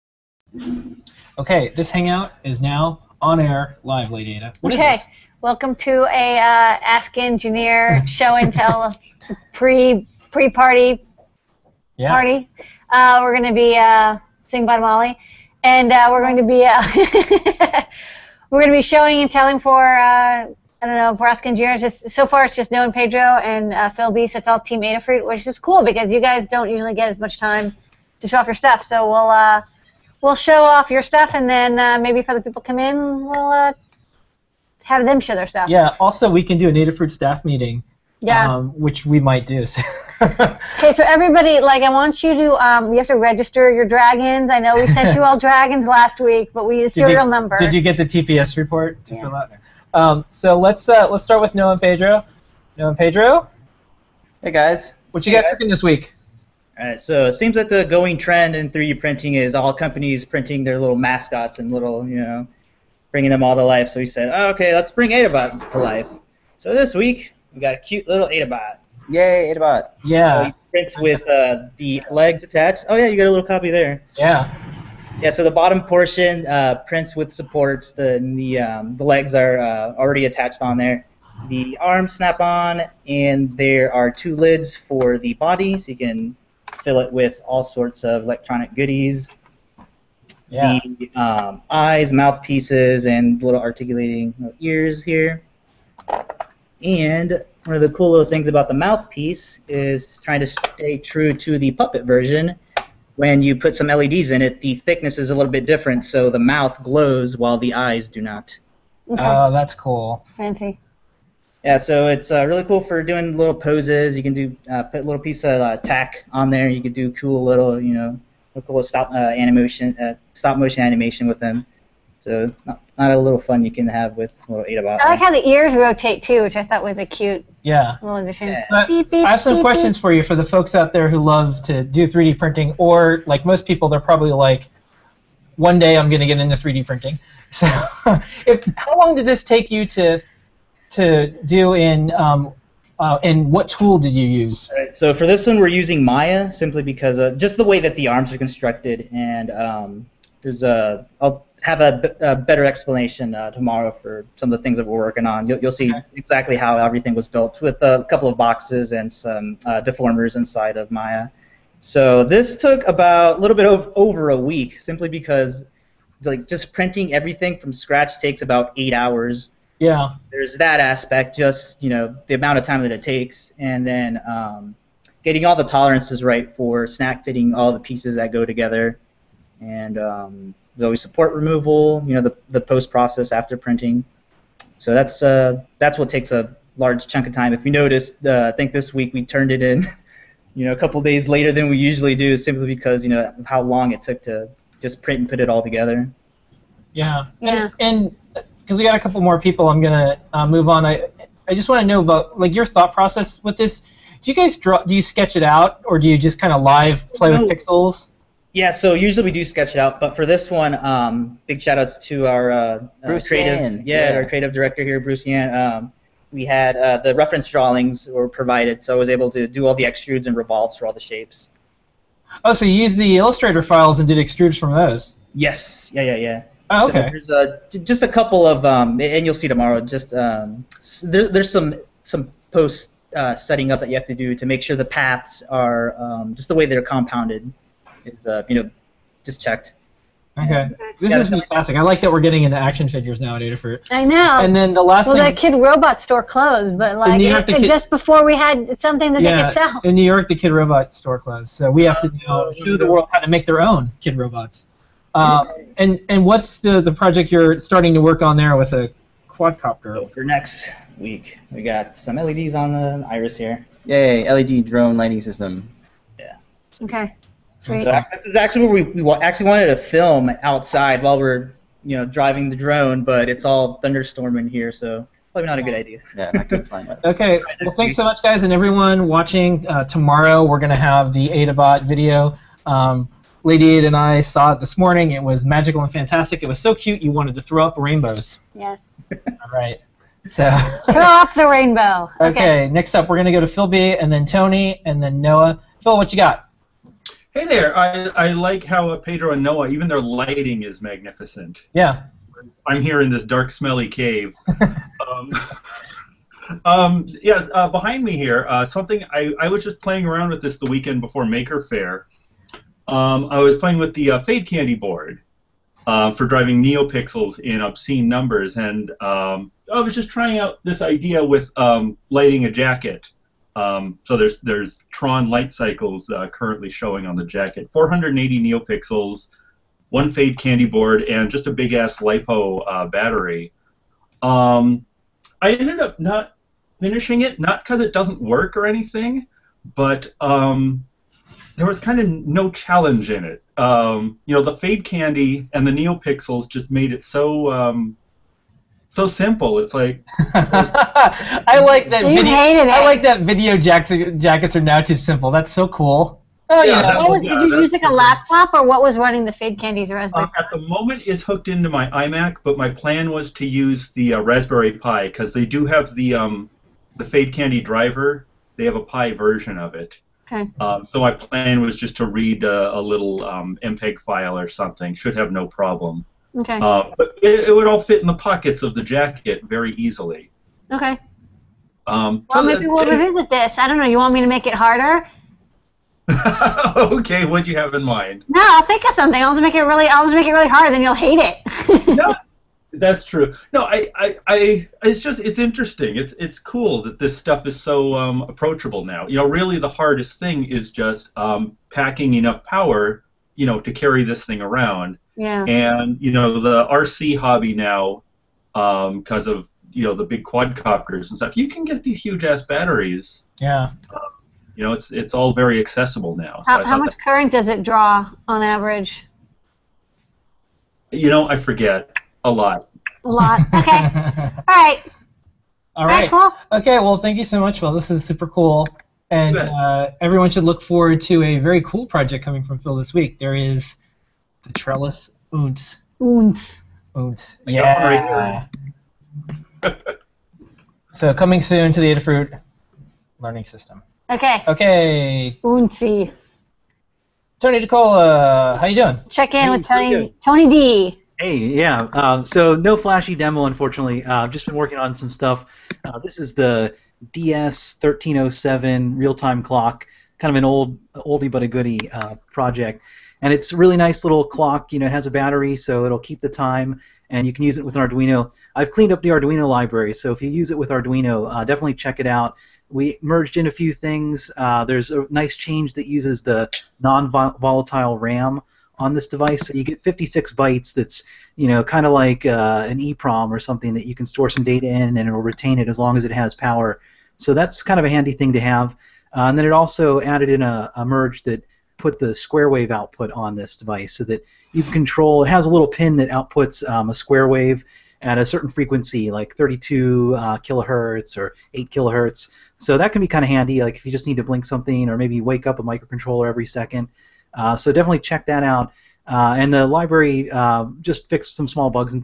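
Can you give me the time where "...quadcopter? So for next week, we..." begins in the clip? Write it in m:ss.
4:19.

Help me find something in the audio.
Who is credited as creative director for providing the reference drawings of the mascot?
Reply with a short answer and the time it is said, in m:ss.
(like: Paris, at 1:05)
Bruce Yan, at 3:34.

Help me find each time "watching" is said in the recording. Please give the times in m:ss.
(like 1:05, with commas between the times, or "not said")
4:39.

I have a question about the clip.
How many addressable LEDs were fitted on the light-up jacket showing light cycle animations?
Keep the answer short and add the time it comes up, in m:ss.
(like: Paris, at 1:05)
480, at 5:27.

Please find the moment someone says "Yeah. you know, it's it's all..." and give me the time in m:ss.
6:53.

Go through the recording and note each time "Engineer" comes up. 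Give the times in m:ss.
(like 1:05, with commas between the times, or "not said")
0:07, 0:21.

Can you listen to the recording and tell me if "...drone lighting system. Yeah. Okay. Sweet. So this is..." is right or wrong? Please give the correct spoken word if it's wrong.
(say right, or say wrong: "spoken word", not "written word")
right.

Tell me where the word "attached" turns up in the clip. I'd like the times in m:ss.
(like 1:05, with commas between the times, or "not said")
1:12, 1:20.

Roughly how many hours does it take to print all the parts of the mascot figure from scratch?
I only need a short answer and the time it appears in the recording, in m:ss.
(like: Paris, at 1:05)
8 hours, at 2:48.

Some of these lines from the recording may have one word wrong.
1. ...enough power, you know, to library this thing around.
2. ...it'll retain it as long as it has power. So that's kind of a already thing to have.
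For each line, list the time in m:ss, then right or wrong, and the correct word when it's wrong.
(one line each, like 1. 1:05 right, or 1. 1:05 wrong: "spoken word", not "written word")
1. 6:42 wrong: "carry", not "library"
2. 8:04 wrong: "handy", not "already".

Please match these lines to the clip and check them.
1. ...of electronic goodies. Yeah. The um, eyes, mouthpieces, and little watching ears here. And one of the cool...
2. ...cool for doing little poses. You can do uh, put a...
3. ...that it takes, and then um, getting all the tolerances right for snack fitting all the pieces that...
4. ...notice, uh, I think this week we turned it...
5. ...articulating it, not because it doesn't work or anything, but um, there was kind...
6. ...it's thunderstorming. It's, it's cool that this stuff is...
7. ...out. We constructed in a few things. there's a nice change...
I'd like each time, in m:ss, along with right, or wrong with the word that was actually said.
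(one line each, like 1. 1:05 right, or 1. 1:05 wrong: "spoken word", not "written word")
1. 1:28 wrong: "articulating", not "watching"
2. 1:52 right
3. 2:52 right
4. 3:07 right
5. 5:36 wrong: "finishing", not "articulating"
6. 6:35 wrong: "interesting", not "thunderstorming"
7. 7:52 wrong: "merged", not "constructed".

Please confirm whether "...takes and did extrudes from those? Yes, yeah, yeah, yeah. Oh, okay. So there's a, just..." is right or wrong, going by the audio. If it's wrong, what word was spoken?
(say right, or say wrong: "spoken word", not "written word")
wrong: "files", not "takes".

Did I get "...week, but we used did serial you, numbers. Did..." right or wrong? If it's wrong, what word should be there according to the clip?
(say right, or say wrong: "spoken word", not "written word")
right.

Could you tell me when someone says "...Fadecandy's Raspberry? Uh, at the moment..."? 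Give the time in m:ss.
5:59.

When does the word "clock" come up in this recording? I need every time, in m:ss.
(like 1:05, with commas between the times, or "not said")
7:39, 7:44.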